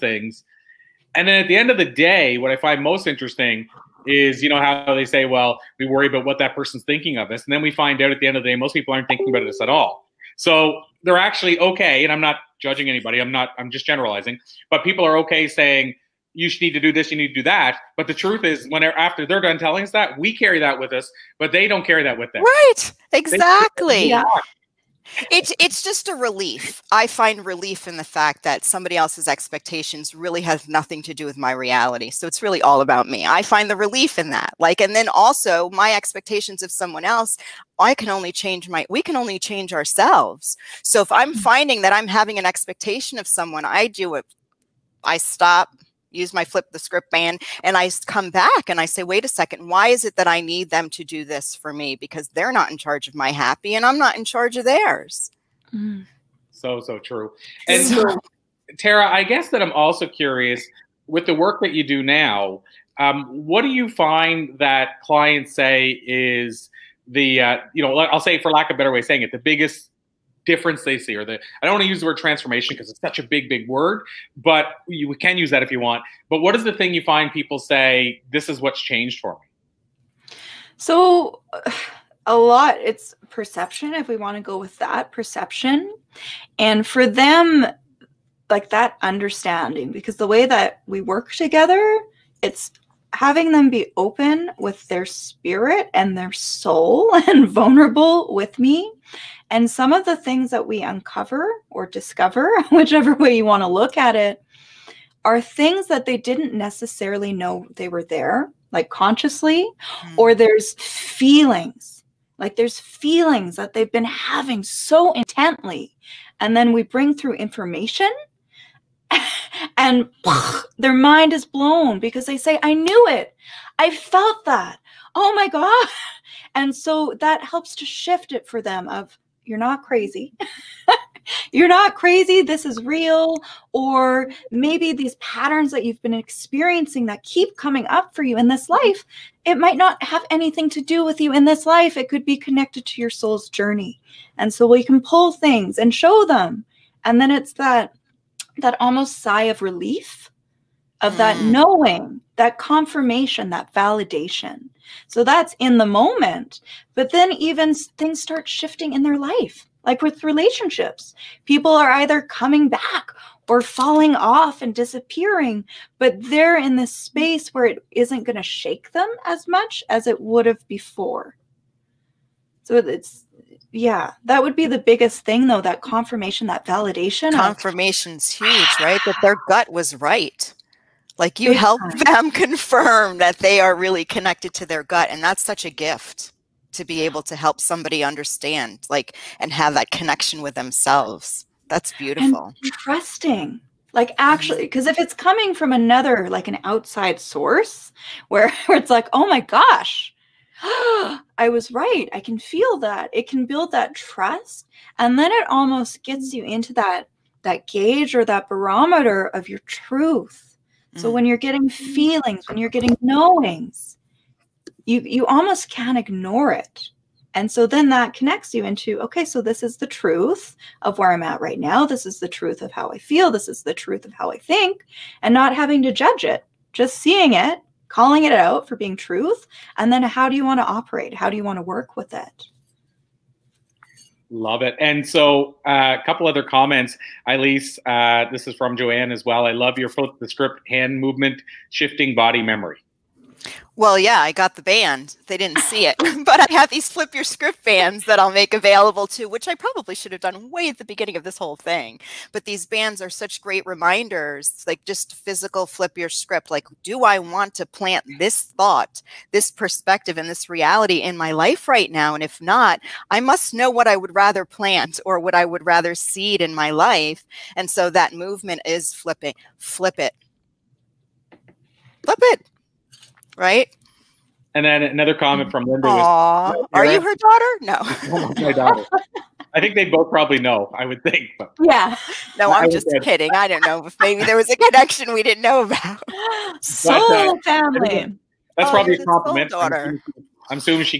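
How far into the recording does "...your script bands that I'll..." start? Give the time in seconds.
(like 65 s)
247 s.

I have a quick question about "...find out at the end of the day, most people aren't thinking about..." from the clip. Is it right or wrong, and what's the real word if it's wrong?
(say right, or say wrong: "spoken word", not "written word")
right.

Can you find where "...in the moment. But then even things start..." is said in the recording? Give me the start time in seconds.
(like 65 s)
155 s.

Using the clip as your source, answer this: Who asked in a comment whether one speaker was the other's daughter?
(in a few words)
Linda.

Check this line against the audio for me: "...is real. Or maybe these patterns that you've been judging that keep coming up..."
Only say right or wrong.
wrong.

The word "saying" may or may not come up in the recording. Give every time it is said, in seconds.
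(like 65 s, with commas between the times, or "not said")
15 s, 69 s.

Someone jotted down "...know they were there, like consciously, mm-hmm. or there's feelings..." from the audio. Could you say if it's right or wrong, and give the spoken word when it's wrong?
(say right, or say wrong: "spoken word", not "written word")
right.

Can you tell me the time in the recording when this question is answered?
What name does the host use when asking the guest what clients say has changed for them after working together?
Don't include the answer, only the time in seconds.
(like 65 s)
58 s.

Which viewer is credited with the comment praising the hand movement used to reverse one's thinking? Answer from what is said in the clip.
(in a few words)
Joanne.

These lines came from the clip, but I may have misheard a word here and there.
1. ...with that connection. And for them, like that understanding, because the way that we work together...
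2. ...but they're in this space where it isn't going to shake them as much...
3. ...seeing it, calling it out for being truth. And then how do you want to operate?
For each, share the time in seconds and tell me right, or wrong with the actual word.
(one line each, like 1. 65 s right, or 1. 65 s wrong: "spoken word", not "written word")
1. 84 s wrong: "perception", not "connection"
2. 165 s right
3. 226 s right.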